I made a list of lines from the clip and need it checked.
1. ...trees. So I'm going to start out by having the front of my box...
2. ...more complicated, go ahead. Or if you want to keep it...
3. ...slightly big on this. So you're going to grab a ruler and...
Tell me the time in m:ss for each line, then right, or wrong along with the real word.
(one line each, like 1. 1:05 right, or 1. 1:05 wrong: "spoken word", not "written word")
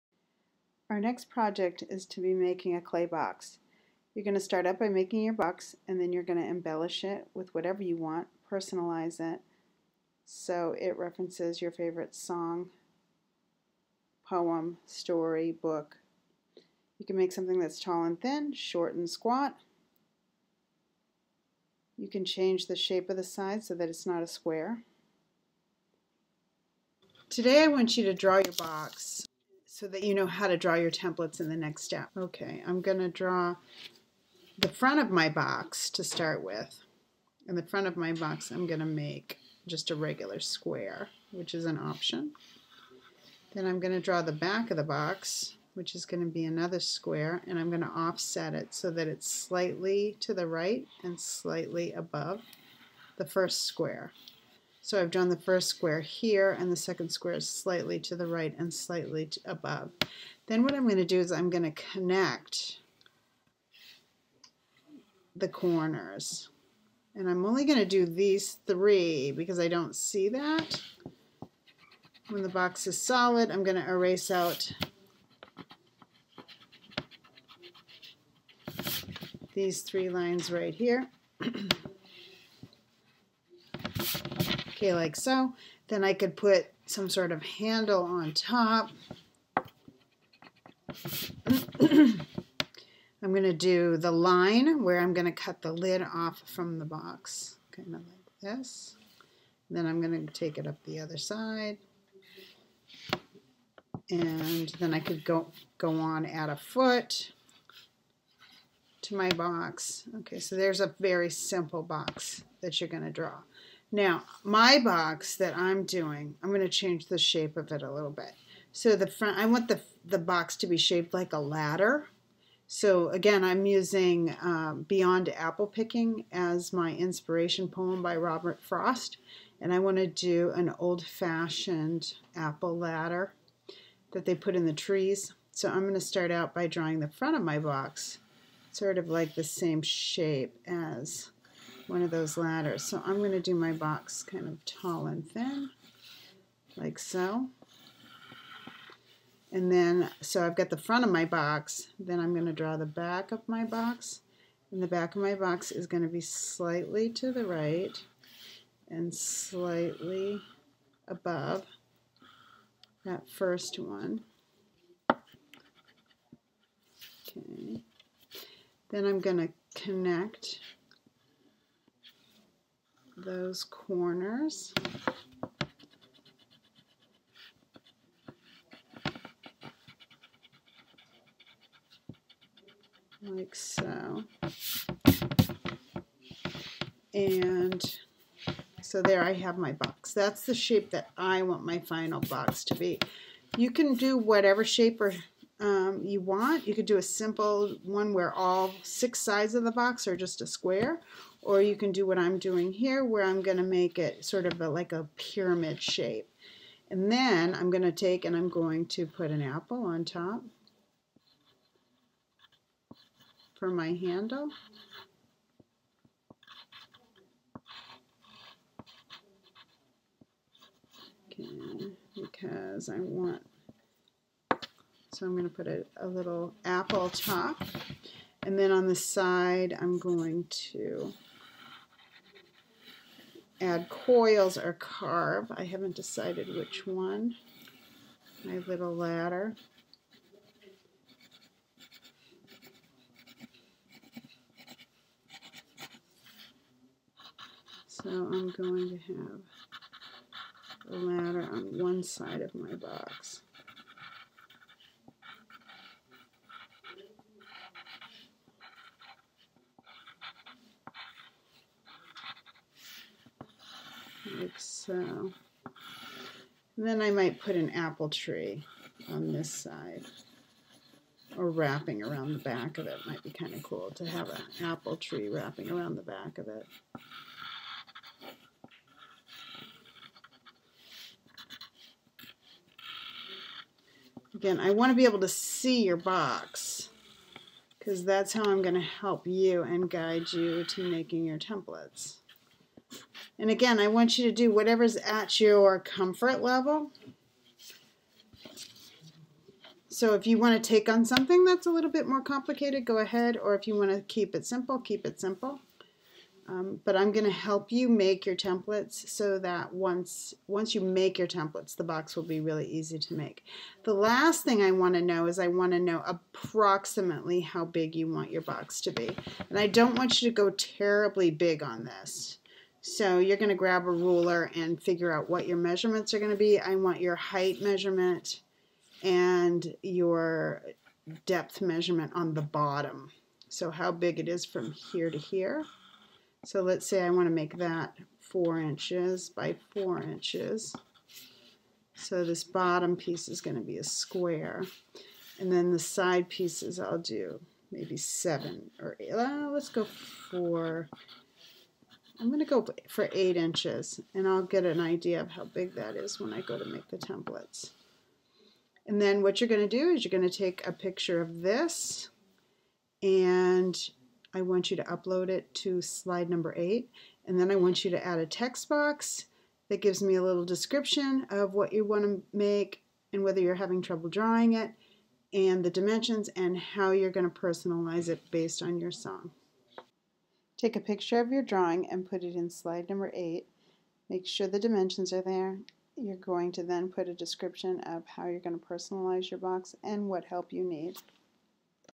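1. 2:14 wrong: "drawing", not "having"
2. 5:02 right
3. 5:20 wrong: "terribly", not "slightly".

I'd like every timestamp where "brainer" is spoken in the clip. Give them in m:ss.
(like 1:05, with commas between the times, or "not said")
not said.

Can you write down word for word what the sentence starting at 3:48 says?
And then on the side, I'm going to add coils or carve.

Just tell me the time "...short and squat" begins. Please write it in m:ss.
0:18.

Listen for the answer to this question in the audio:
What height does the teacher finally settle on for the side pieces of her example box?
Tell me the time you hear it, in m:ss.
5:53.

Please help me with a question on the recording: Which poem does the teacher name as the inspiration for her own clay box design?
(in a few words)
Beyond Apple Picking.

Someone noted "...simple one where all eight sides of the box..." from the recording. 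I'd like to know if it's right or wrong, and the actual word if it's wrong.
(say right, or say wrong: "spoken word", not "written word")
wrong: "six", not "eight".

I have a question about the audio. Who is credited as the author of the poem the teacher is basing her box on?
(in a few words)
Robert Frost.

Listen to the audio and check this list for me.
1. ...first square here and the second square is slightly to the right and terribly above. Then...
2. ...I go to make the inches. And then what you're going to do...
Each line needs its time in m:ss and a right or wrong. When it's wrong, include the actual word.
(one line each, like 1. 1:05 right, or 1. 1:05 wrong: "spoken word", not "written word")
1. 0:55 wrong: "slightly", not "terribly"
2. 5:56 wrong: "templates", not "inches".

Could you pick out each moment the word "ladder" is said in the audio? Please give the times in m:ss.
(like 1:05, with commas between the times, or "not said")
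2:01, 2:12, 2:22, 3:58, 4:10.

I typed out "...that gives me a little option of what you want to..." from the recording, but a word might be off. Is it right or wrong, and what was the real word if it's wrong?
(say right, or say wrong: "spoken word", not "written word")
wrong: "description", not "option".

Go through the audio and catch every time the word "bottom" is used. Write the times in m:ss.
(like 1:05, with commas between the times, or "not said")
5:32, 5:42.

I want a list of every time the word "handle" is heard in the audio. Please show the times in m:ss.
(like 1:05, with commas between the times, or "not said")
1:27, 3:33.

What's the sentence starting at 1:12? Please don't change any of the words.
When the box is solid, I'm going to erase out these three lines right here.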